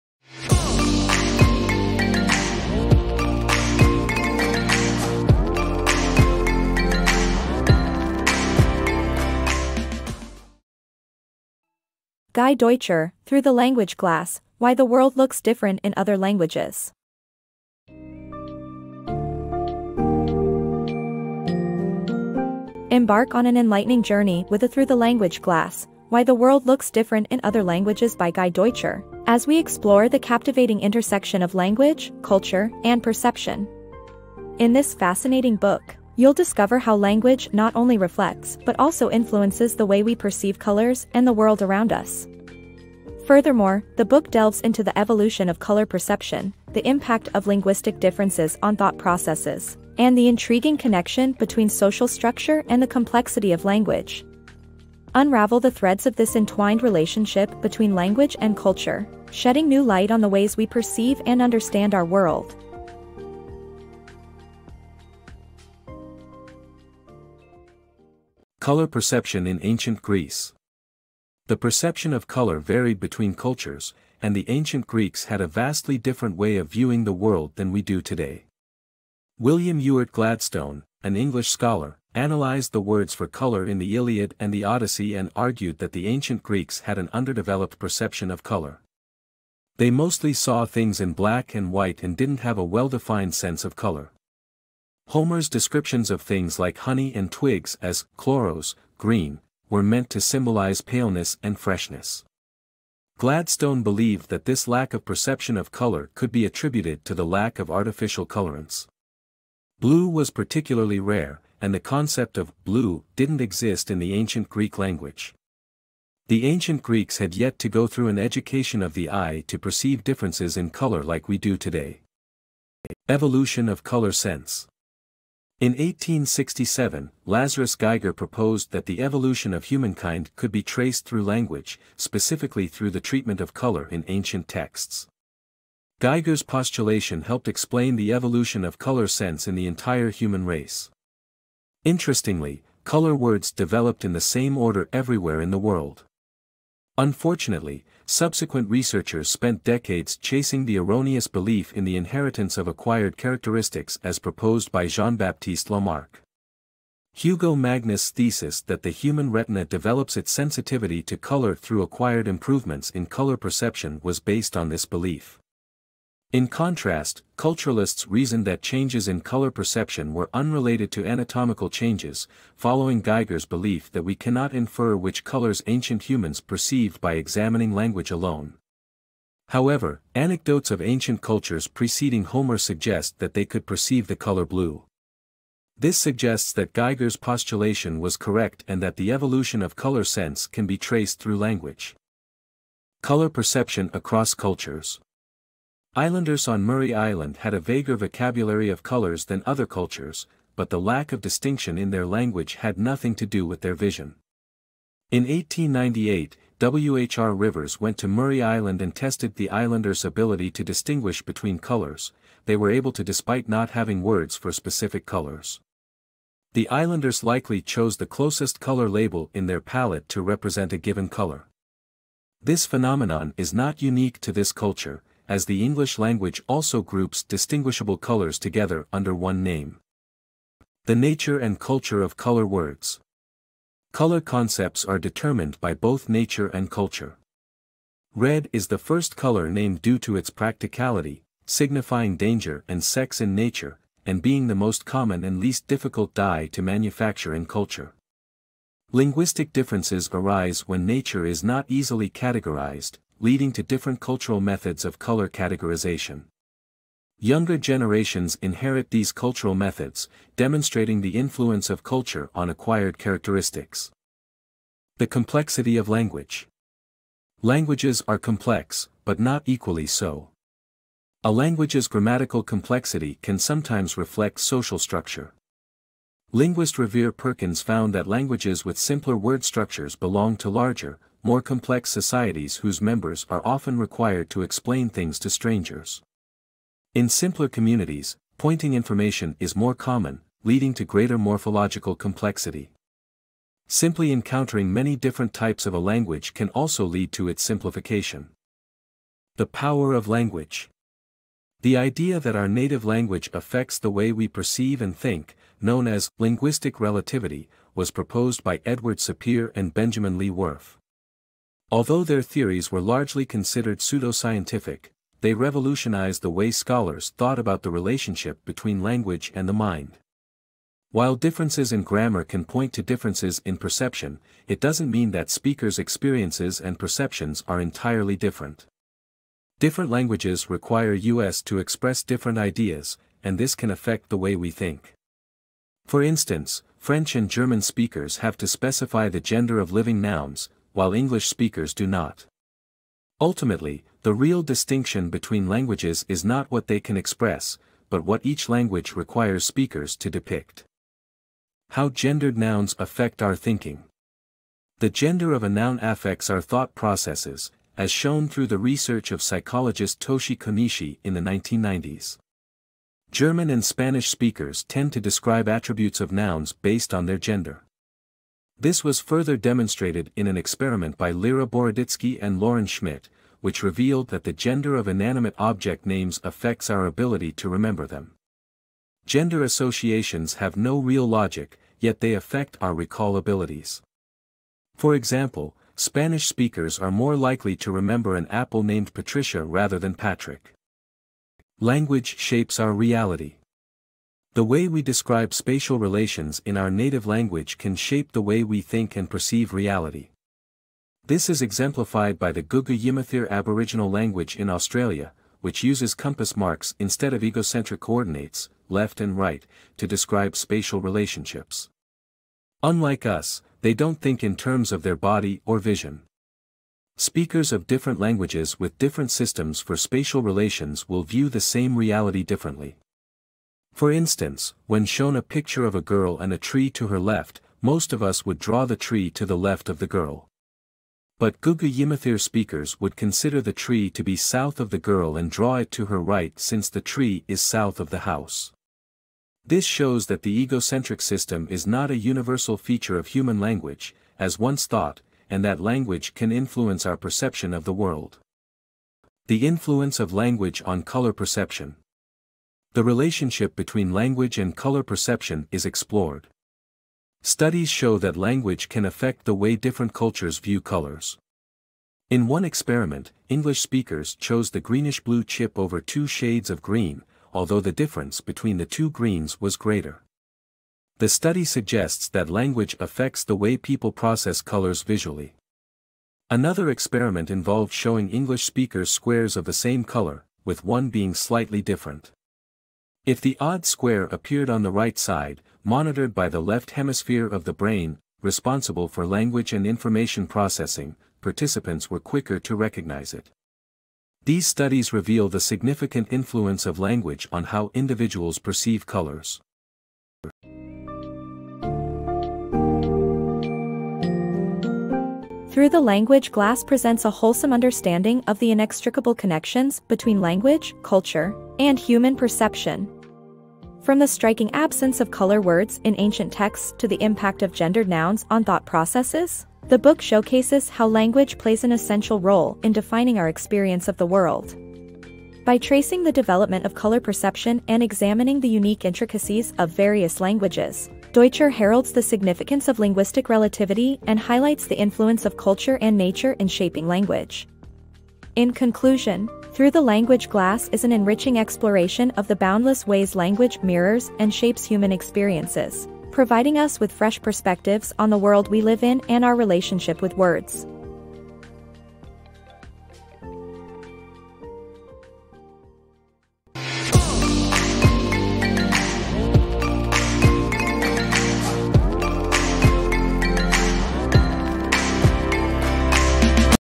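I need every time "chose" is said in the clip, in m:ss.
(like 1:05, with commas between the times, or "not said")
3:37, 7:44.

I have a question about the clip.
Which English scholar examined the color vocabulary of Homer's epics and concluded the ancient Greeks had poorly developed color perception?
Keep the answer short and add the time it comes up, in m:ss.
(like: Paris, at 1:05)
William Ewart Gladstone, at 1:19.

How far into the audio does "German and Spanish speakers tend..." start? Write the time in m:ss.
6:03.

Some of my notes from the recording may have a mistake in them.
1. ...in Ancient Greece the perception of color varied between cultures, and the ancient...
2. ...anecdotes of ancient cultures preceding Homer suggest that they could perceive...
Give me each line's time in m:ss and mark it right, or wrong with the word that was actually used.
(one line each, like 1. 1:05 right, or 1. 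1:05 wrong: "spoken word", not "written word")
1. 1:09 right
2. 3:00 right.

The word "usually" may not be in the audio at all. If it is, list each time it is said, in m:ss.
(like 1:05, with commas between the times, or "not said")
not said.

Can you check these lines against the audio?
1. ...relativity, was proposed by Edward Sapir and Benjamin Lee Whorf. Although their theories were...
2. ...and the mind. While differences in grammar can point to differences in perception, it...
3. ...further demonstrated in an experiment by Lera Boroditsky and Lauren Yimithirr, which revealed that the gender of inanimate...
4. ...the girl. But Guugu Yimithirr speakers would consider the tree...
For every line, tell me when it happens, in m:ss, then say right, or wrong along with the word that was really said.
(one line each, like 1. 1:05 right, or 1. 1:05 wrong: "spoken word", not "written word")
1. 5:06 right
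2. 5:19 right
3. 6:08 wrong: "Schmidt", not "Yimithirr"
4. 7:09 right.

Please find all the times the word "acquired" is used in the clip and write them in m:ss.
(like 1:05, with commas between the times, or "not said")
2:32, 2:41, 4:22.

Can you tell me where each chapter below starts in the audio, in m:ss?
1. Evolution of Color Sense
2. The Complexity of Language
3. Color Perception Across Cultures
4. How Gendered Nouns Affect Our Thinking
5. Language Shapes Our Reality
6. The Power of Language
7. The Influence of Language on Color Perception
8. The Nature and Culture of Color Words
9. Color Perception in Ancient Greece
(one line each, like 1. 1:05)
1. 2:03
2. 4:25
3. 3:13
4. 5:52
5. 6:32
6. 5:00
7. 7:29
8. 3:51
9. 1:09.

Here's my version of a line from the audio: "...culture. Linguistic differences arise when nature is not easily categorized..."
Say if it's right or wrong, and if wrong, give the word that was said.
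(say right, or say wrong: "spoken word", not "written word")
right.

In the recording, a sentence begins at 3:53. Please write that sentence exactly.
Color concepts are determined by both nature and culture.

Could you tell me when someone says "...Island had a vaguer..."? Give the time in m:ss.
3:16.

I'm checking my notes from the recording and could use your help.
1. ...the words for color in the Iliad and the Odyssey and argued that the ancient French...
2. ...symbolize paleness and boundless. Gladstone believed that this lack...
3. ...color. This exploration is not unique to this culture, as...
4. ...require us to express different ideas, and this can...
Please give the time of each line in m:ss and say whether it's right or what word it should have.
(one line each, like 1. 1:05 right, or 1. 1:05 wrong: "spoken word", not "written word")
1. 1:22 wrong: "Greeks", not "French"
2. 1:40 wrong: "freshness", not "boundless"
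3. 3:41 wrong: "phenomenon", not "exploration"
4. 5:30 right.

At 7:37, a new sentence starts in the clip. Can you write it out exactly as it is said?
Studies show that language can affect the way different cultures view colors.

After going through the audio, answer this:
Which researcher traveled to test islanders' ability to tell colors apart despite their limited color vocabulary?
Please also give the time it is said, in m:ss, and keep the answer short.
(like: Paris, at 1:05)
W.H.R. Rivers, at 3:26.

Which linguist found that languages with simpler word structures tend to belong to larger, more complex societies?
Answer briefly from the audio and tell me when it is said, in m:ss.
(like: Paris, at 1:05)
Revere Perkins, at 4:36.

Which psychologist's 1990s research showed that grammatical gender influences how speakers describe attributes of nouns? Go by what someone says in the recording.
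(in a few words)
Toshi Konishi.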